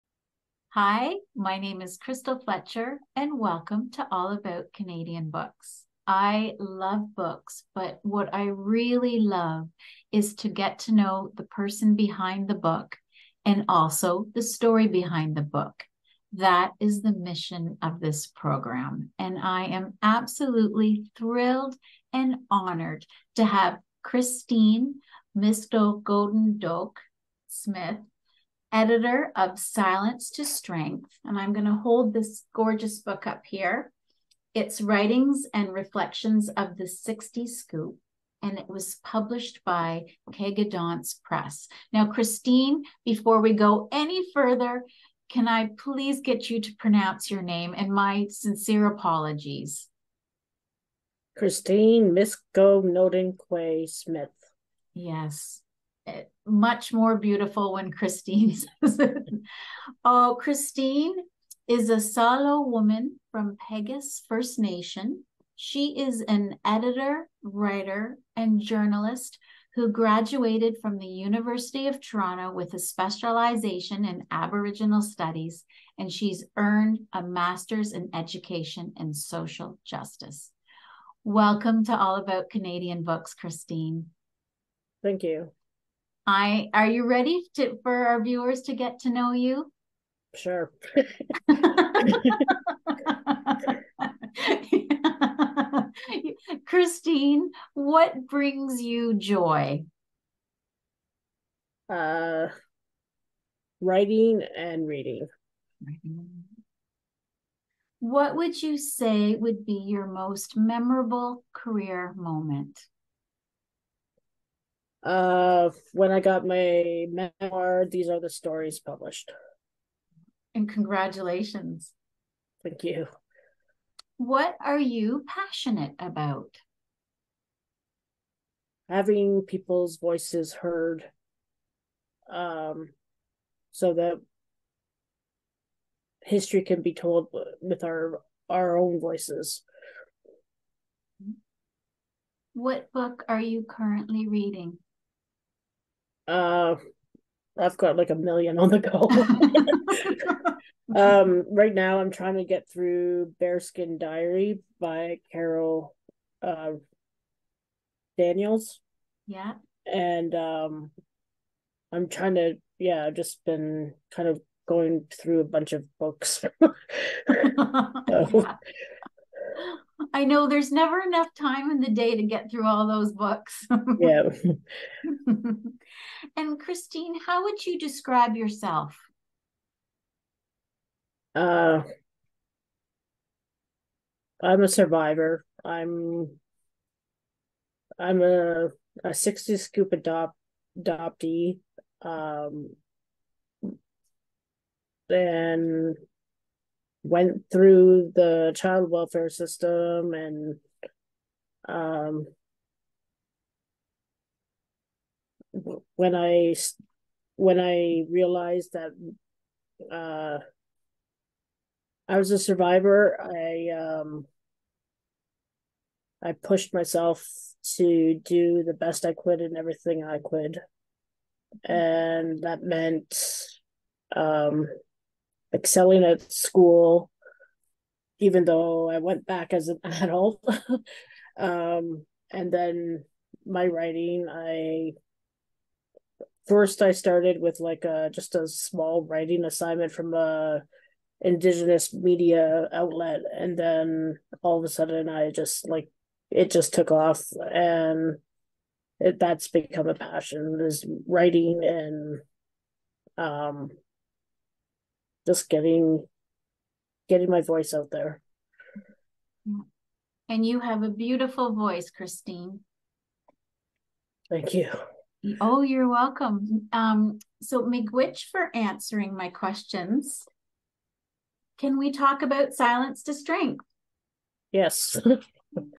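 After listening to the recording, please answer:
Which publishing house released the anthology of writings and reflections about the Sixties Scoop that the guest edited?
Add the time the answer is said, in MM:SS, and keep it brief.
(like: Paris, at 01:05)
Kegedonce Press, at 00:40.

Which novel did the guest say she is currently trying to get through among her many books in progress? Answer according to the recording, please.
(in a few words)
Bearskin Diary.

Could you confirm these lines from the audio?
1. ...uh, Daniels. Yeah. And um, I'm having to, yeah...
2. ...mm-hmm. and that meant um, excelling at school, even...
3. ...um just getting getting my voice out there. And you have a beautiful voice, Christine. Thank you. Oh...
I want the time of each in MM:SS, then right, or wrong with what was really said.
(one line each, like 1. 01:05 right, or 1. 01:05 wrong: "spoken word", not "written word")
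1. 02:36 wrong: "trying", not "having"
2. 03:41 right
3. 04:13 right.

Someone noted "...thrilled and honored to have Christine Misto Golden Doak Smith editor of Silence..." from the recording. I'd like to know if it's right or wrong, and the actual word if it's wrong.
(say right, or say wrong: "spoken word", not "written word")
right.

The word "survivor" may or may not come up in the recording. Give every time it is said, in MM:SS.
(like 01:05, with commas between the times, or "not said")
03:04, 03:32.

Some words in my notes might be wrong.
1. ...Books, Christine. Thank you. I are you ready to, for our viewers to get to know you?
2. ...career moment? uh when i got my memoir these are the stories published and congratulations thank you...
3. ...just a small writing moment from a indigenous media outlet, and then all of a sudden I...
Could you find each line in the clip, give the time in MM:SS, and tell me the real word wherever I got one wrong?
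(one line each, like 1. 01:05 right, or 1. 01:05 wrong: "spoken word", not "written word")
1. 01:23 right
2. 01:51 right
3. 03:58 wrong: "assignment", not "moment".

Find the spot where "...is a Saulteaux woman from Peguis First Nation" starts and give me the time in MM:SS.
01:01.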